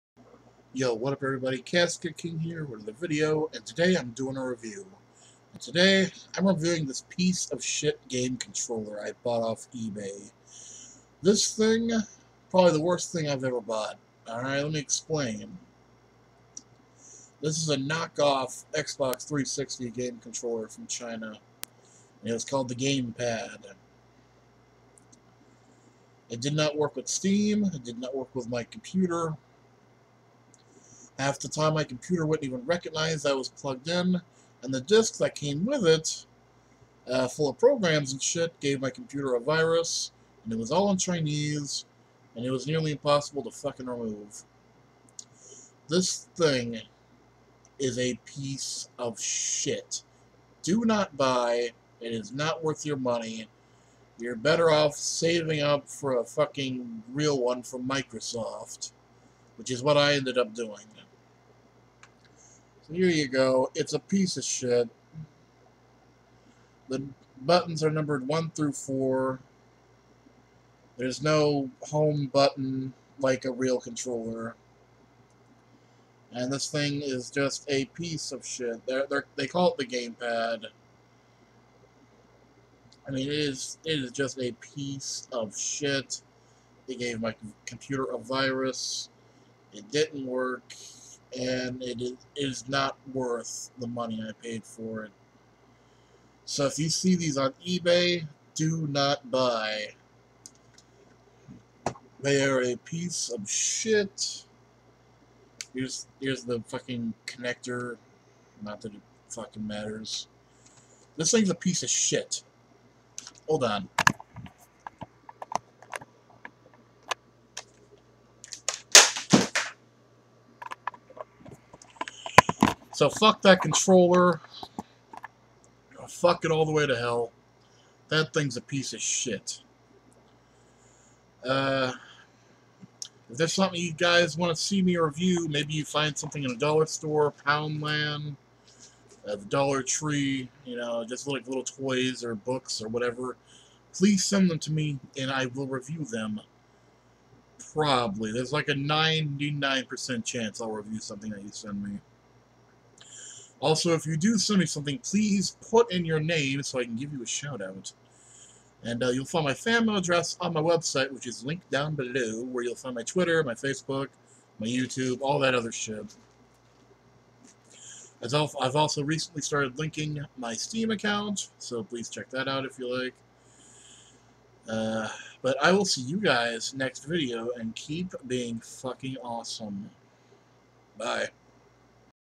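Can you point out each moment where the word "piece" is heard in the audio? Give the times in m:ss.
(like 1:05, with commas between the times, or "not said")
0:07, 0:48, 1:03, 1:17, 1:24, 1:42, 1:51, 2:08.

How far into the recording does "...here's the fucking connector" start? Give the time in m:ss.
1:46.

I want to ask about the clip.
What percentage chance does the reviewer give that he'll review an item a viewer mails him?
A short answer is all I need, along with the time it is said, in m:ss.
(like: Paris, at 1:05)
99%, at 2:28.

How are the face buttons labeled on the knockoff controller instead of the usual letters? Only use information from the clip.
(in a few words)
1 through 4.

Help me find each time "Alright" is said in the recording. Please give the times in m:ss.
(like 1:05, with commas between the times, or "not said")
0:14.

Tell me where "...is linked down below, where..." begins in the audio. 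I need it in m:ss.
2:41.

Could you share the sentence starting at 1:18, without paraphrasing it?
They're, they're, they call it the gamepad.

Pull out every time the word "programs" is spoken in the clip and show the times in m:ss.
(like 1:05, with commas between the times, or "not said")
0:37.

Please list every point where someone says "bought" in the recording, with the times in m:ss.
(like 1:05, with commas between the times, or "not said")
0:09, 0:13.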